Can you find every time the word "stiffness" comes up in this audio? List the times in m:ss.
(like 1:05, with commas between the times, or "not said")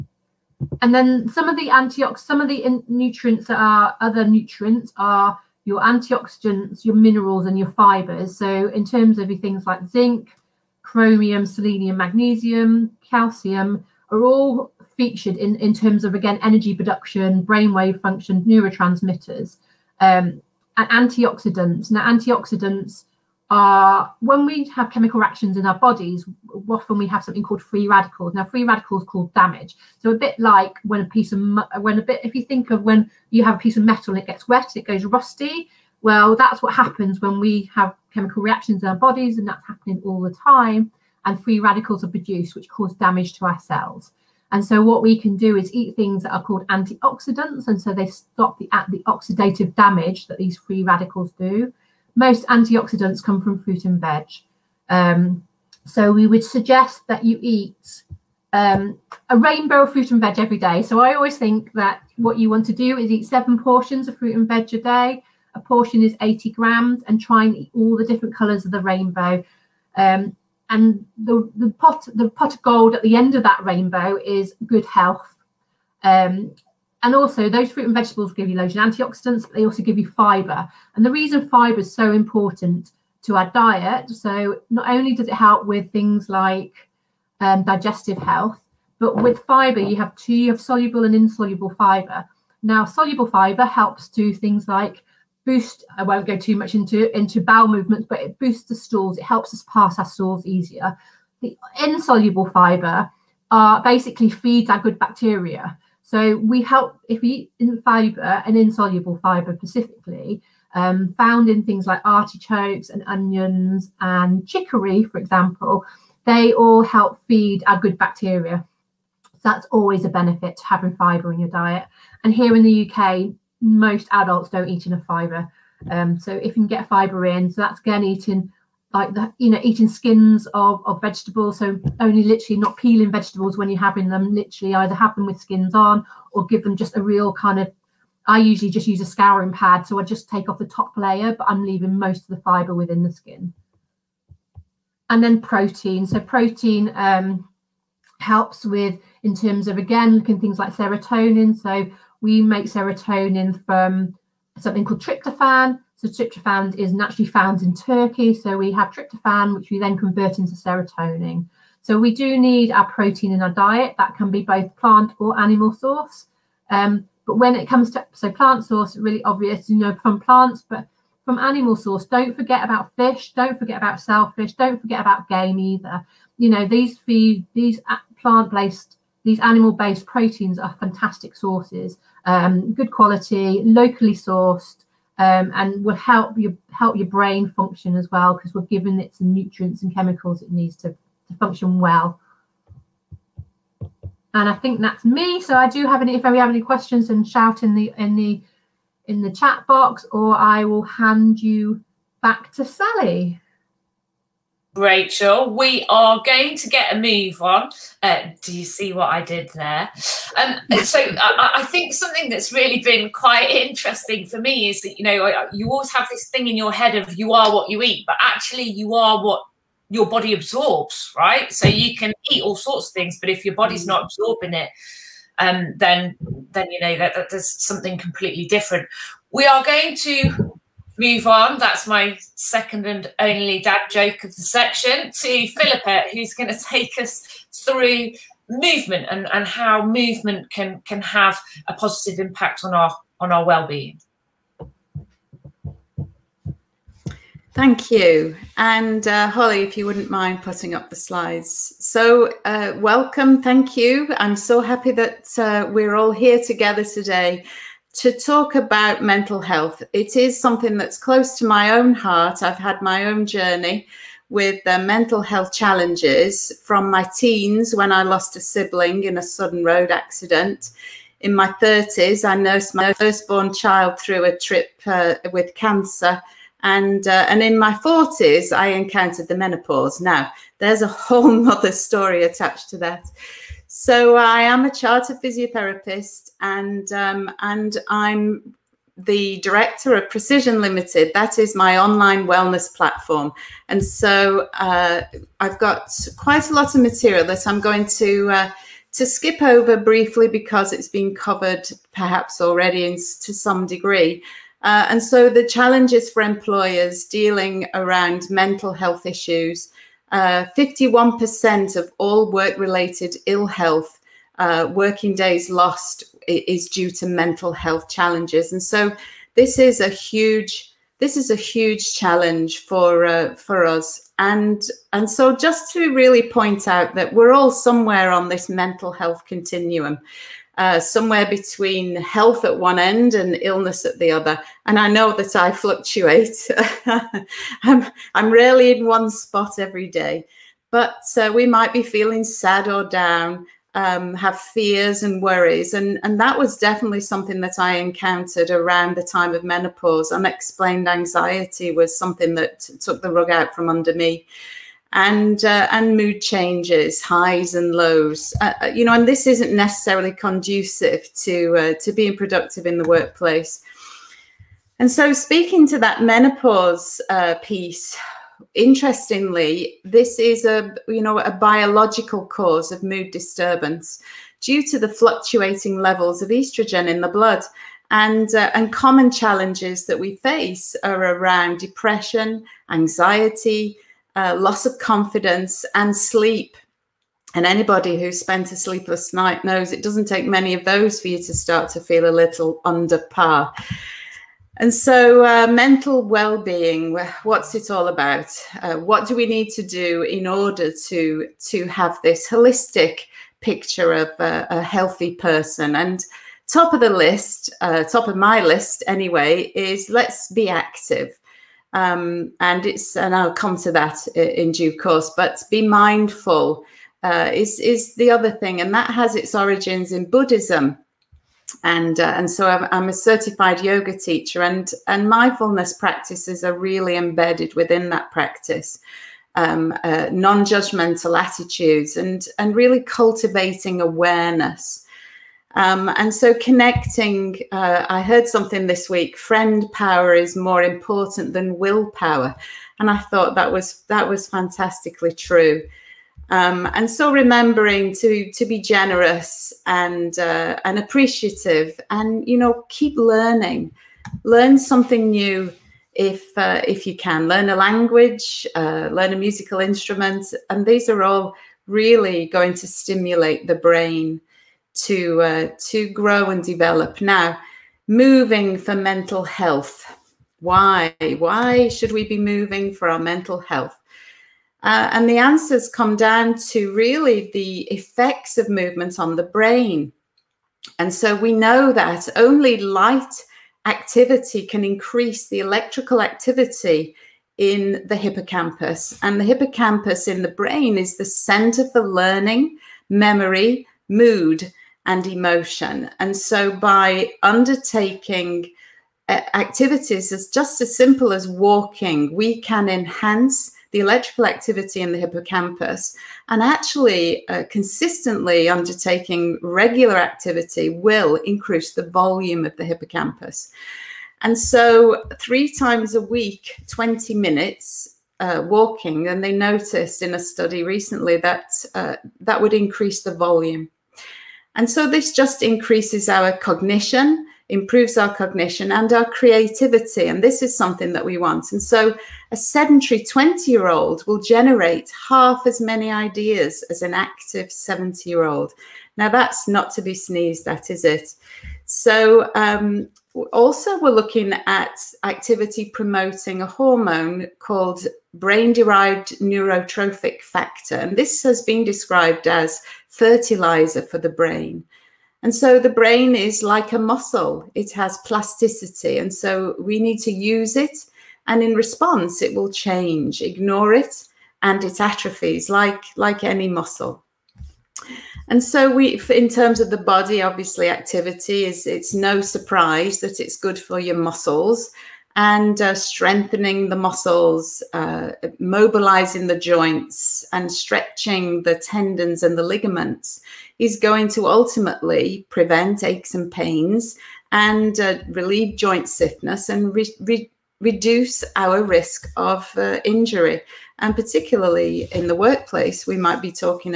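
9:48.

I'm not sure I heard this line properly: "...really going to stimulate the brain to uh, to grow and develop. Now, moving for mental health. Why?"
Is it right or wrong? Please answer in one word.
right.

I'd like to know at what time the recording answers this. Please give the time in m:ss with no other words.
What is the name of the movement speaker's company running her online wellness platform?
4:50.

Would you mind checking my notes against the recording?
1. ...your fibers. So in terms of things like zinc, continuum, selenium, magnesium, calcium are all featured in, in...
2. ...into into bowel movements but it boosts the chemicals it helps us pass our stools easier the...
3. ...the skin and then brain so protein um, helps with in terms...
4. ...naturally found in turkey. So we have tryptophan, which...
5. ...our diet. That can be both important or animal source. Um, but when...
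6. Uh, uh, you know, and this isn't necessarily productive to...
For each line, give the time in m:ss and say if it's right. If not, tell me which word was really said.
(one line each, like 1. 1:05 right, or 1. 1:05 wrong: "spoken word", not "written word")
1. 0:07 wrong: "chromium", not "continuum"
2. 1:36 wrong: "stools", not "chemicals"
3. 2:23 wrong: "protein", not "brain"
4. 2:36 right
5. 2:43 wrong: "plant", not "important"
6. 5:58 wrong: "conducive", not "productive".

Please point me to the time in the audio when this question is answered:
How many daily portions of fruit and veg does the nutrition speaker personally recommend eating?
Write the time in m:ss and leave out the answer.
1:03.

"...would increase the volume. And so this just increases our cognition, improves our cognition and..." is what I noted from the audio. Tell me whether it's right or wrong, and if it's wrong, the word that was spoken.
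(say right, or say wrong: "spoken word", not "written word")
right.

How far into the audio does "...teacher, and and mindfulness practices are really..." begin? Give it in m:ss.
7:03.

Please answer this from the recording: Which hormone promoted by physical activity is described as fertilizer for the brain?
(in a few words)
brain-derived neurotrophic factor.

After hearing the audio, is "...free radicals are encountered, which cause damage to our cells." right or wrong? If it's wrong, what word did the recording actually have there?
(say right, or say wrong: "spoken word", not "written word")
wrong: "produced", not "encountered".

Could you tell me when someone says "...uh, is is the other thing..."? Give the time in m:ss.
6:57.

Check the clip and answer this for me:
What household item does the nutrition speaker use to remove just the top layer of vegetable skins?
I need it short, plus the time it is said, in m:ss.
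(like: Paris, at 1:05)
a scouring pad, at 2:19.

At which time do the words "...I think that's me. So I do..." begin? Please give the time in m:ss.
3:14.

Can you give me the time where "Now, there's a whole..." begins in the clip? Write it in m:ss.
4:39.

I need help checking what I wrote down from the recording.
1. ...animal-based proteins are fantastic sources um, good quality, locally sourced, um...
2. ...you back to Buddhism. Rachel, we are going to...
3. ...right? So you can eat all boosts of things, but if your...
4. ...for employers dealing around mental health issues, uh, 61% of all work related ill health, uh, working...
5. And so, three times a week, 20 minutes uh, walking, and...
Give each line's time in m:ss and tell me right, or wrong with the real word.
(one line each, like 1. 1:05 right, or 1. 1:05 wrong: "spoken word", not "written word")
1. 2:59 right
2. 3:21 wrong: "Sally", not "Buddhism"
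3. 3:41 wrong: "sorts", not "boosts"
4. 5:06 wrong: "51", not "61"
5. 8:34 right.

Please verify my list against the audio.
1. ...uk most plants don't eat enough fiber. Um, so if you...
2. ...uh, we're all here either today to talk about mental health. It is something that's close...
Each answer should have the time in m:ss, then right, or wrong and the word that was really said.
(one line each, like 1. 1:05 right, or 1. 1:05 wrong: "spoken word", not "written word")
1. 2:02 wrong: "adults", not "plants"
2. 4:15 wrong: "together", not "either".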